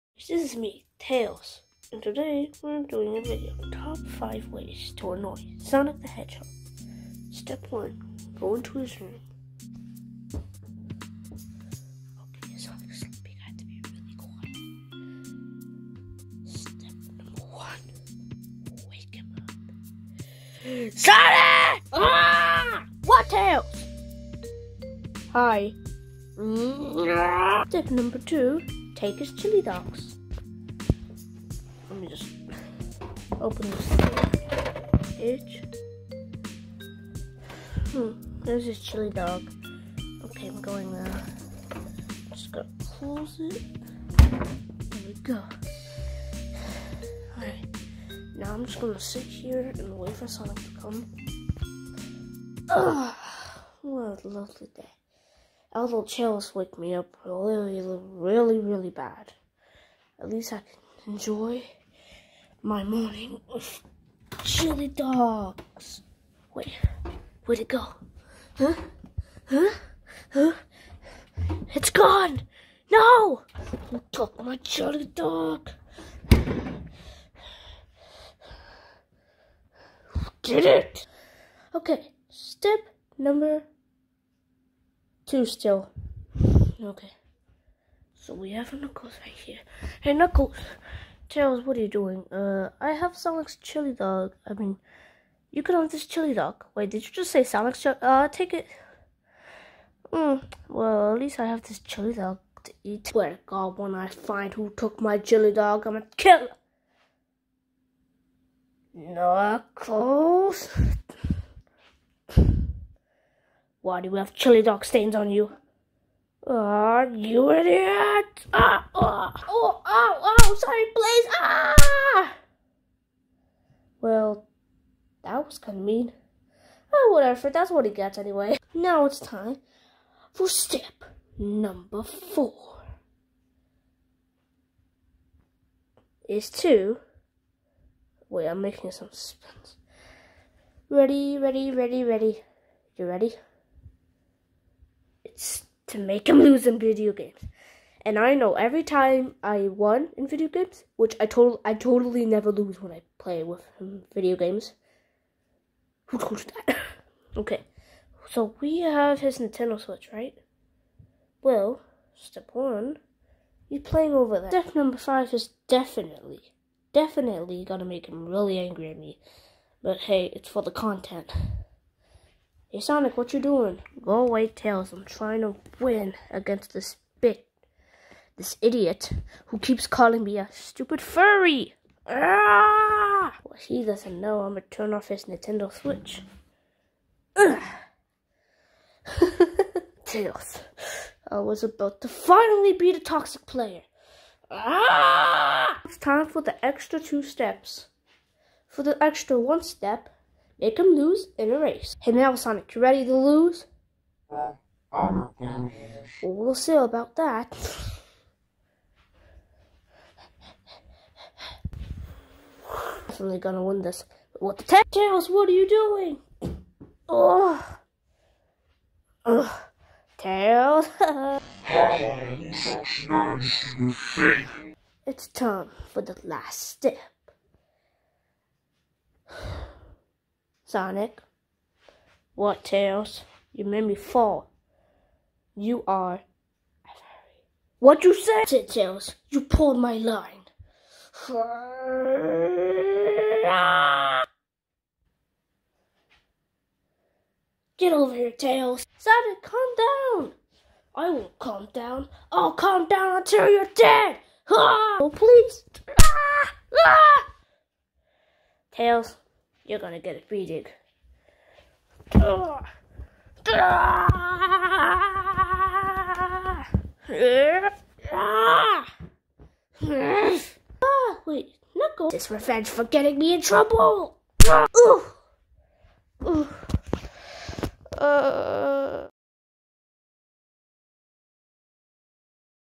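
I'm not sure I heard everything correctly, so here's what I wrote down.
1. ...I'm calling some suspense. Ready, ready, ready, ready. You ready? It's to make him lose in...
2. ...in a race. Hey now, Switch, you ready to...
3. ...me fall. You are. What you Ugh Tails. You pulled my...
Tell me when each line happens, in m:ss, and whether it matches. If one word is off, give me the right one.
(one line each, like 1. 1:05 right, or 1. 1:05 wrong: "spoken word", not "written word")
1. 2:18 wrong: "making", not "calling"
2. 3:21 wrong: "Sonic", not "Switch"
3. 3:53 wrong: "Said", not "Ugh".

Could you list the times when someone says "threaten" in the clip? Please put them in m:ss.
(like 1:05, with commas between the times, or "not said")
not said.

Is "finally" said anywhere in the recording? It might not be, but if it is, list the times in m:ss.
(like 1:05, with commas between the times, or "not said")
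3:12.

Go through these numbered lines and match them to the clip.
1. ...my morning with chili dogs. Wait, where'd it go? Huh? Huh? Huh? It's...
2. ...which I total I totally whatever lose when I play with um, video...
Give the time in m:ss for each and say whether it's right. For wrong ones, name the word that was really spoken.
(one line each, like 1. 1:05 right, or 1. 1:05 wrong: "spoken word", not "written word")
1. 1:02 right
2. 2:30 wrong: "never", not "whatever".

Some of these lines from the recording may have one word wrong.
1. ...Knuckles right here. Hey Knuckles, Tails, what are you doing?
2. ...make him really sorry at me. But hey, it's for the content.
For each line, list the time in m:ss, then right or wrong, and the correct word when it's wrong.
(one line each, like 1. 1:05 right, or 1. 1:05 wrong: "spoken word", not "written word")
1. 1:28 right
2. 2:47 wrong: "angry", not "sorry".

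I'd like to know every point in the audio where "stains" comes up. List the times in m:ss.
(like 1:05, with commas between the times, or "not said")
1:54.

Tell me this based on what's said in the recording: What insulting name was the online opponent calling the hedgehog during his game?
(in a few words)
Stupid furry.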